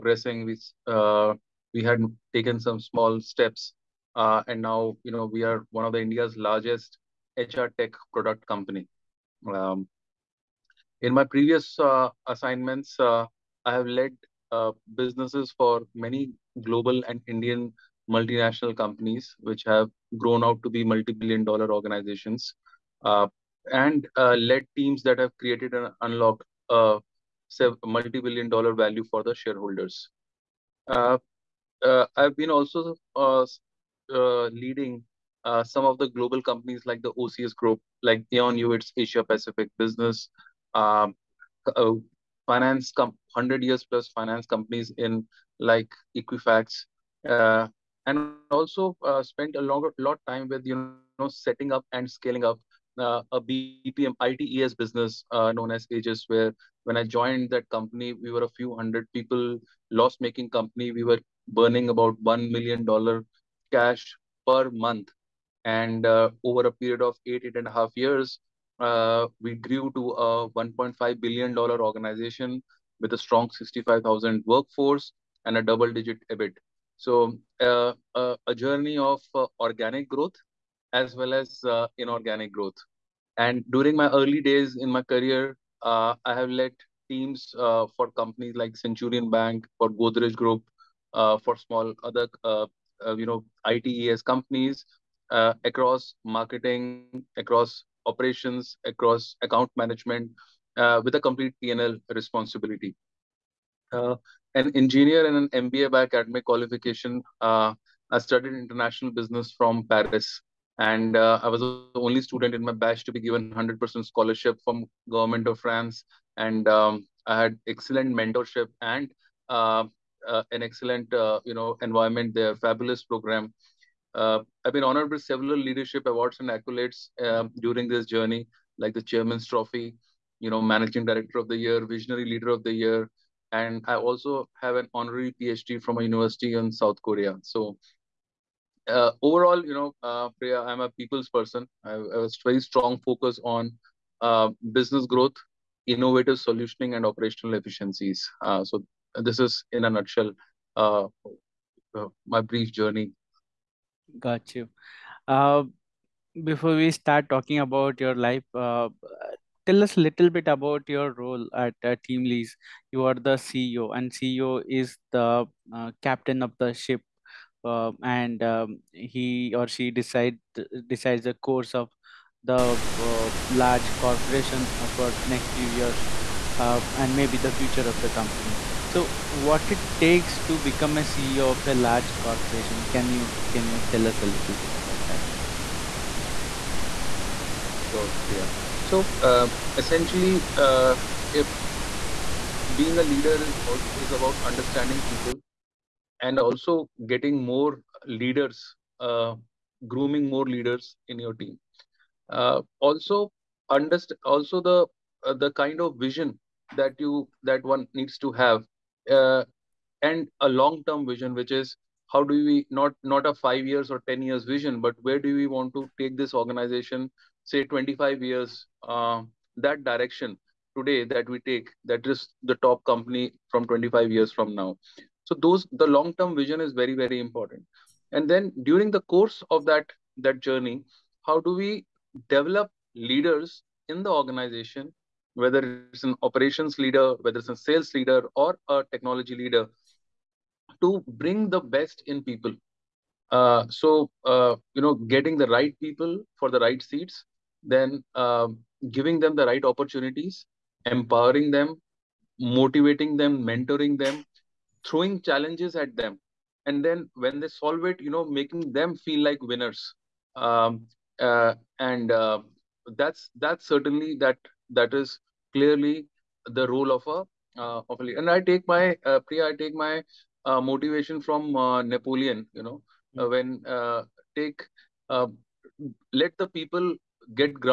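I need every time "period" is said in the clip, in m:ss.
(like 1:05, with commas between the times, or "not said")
1:06.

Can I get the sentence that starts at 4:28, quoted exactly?
and i take my uh, priya i take my uh, motivation from uh, napoleon you know mm-hmm.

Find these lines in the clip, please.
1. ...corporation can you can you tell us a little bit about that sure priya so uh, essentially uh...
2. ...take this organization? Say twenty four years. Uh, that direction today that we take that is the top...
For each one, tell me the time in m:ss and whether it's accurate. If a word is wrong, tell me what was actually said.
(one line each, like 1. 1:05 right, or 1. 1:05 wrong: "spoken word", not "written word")
1. 3:02 right
2. 3:35 wrong: "five", not "four".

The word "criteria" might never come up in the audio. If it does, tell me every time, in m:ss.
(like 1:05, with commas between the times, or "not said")
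not said.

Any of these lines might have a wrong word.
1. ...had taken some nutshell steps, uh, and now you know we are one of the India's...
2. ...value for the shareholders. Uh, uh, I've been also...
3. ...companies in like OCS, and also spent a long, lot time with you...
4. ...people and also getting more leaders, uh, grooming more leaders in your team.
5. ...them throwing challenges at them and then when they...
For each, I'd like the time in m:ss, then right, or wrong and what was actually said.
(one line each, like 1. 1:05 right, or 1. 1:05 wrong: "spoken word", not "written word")
1. 0:01 wrong: "small", not "nutshell"
2. 0:28 right
3. 0:44 wrong: "Equifax", not "OCS"
4. 3:15 right
5. 4:14 right.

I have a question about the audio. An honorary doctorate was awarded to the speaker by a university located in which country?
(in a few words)
South Korea.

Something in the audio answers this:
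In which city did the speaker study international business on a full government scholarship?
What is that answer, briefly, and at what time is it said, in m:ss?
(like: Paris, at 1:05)
Paris, at 1:49.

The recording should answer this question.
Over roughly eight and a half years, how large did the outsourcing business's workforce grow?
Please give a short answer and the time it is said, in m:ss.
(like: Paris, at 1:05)
65,000, at 1:13.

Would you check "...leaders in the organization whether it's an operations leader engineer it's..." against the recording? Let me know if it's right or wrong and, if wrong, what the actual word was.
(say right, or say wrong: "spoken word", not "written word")
wrong: "whether", not "engineer".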